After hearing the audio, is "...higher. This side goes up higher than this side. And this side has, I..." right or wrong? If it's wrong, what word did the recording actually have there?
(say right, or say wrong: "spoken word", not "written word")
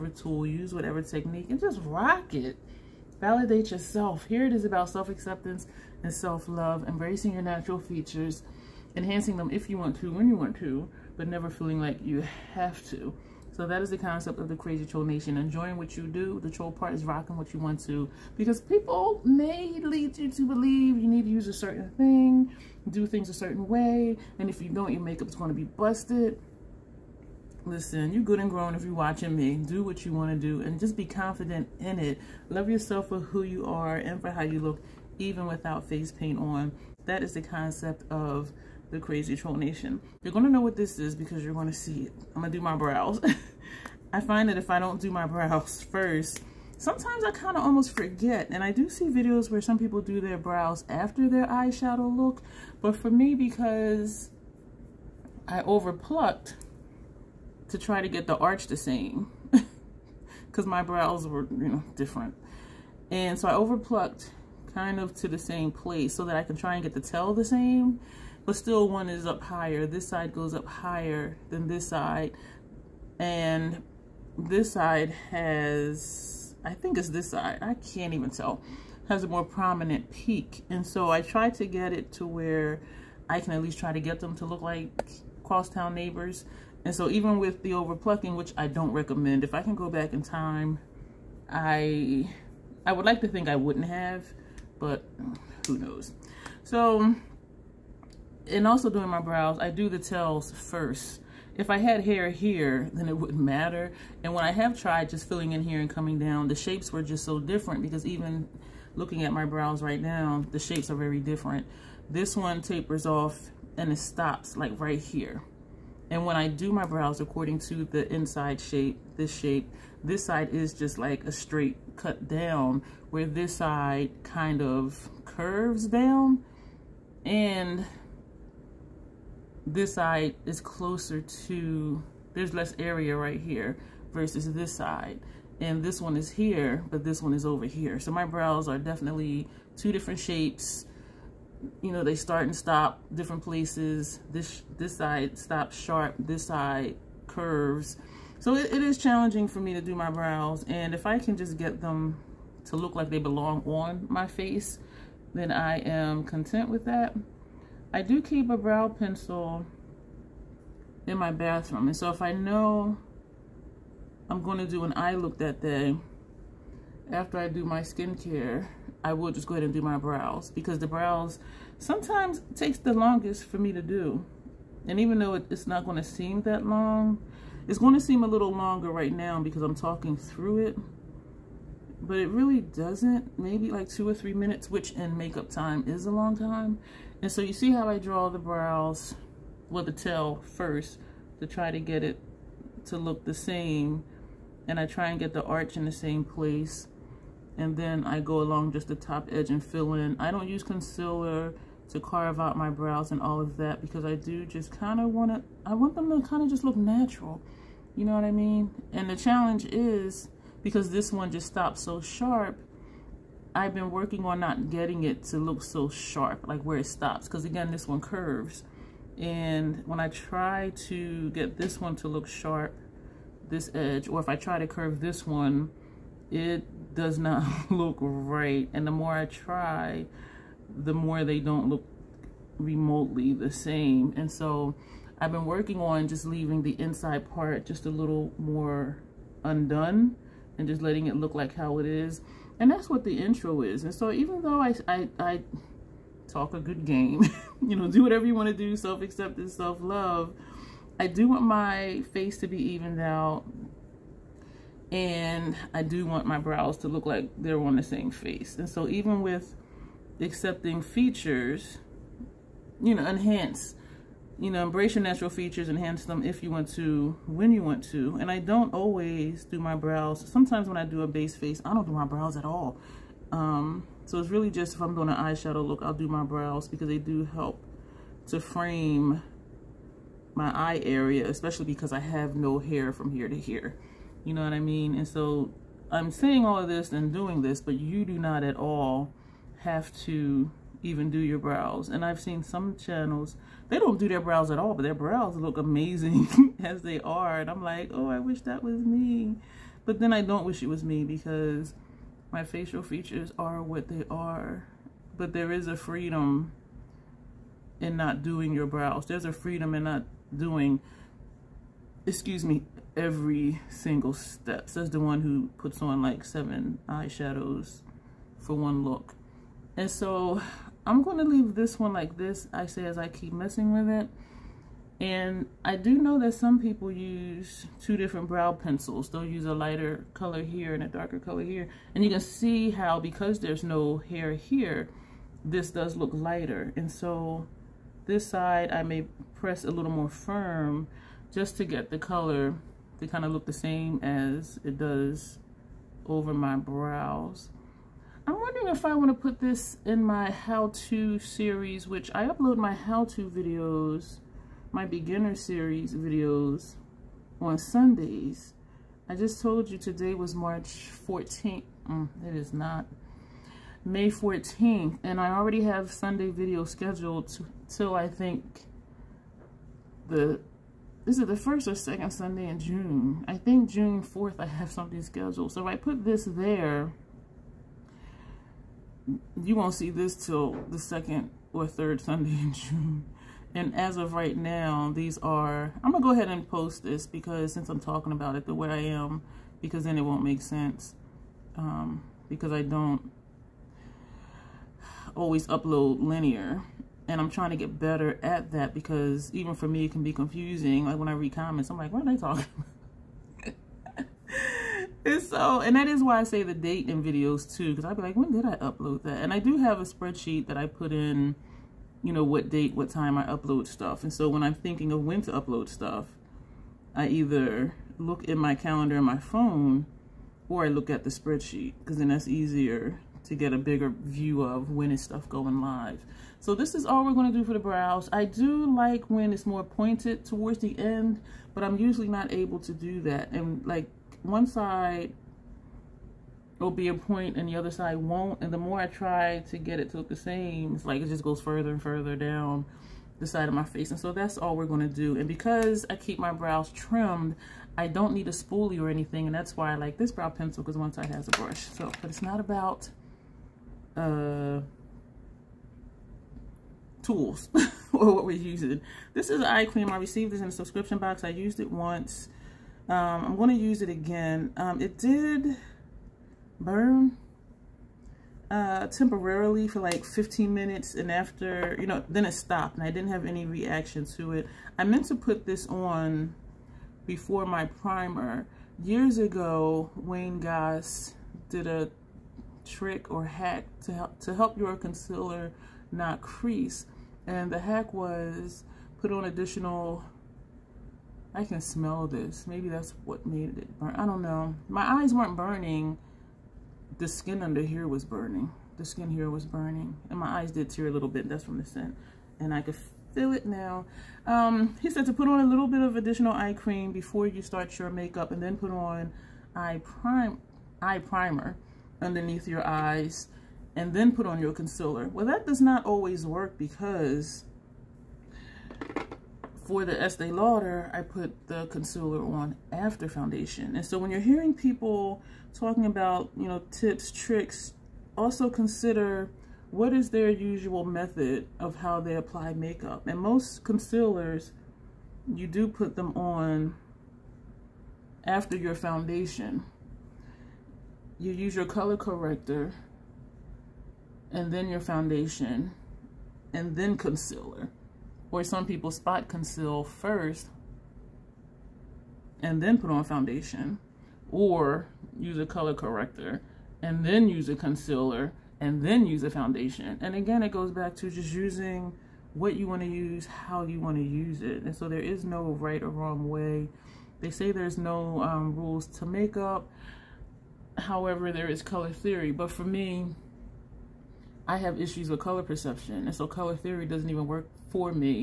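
right.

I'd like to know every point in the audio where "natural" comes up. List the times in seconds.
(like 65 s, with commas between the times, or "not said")
7 s, 206 s, 265 s.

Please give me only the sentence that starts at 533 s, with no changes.
And most concealers, you do put them on after your foundation.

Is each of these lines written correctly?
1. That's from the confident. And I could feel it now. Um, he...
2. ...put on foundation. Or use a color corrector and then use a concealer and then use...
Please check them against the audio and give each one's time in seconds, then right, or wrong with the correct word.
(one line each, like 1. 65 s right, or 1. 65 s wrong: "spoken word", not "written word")
1. 501 s wrong: "scent", not "confident"
2. 552 s right.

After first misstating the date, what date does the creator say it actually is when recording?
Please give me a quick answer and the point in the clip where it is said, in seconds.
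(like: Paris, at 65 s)
May 14th, at 363 s.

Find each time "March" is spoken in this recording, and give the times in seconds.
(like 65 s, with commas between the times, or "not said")
360 s.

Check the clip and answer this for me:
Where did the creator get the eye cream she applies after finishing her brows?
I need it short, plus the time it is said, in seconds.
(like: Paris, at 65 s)
a subscription box, at 460 s.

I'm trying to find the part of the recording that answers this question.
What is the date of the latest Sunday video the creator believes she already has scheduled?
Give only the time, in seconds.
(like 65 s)
373 s.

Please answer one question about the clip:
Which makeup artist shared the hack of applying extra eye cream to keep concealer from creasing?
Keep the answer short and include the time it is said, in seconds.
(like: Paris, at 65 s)
Wayne Goss, at 479 s.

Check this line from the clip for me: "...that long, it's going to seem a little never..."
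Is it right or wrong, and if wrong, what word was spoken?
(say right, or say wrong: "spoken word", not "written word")
wrong: "longer", not "never".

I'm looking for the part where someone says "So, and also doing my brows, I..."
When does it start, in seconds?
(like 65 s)
96 s.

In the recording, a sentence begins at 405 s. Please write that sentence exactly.
and so, and that is why I say the date in videos too, because I'd be like, when did I upload that?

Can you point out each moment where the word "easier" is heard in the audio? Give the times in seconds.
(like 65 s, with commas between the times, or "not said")
422 s.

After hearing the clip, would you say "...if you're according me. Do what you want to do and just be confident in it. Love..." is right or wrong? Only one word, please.
wrong.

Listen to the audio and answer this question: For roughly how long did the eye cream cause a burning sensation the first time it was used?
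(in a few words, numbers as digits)
15 minutes.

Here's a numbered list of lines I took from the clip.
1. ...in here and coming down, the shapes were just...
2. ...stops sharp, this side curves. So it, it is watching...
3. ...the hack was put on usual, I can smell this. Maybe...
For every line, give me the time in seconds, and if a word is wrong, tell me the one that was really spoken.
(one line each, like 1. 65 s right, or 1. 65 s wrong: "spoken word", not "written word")
1. 105 s right
2. 145 s wrong: "challenging", not "watching"
3. 487 s wrong: "additional", not "usual".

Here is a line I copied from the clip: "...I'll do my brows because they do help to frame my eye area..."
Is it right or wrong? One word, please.
right.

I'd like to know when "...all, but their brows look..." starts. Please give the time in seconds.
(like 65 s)
294 s.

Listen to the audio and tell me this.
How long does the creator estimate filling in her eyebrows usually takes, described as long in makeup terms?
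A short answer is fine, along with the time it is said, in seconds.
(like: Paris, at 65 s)
2 or 3 minutes, at 183 s.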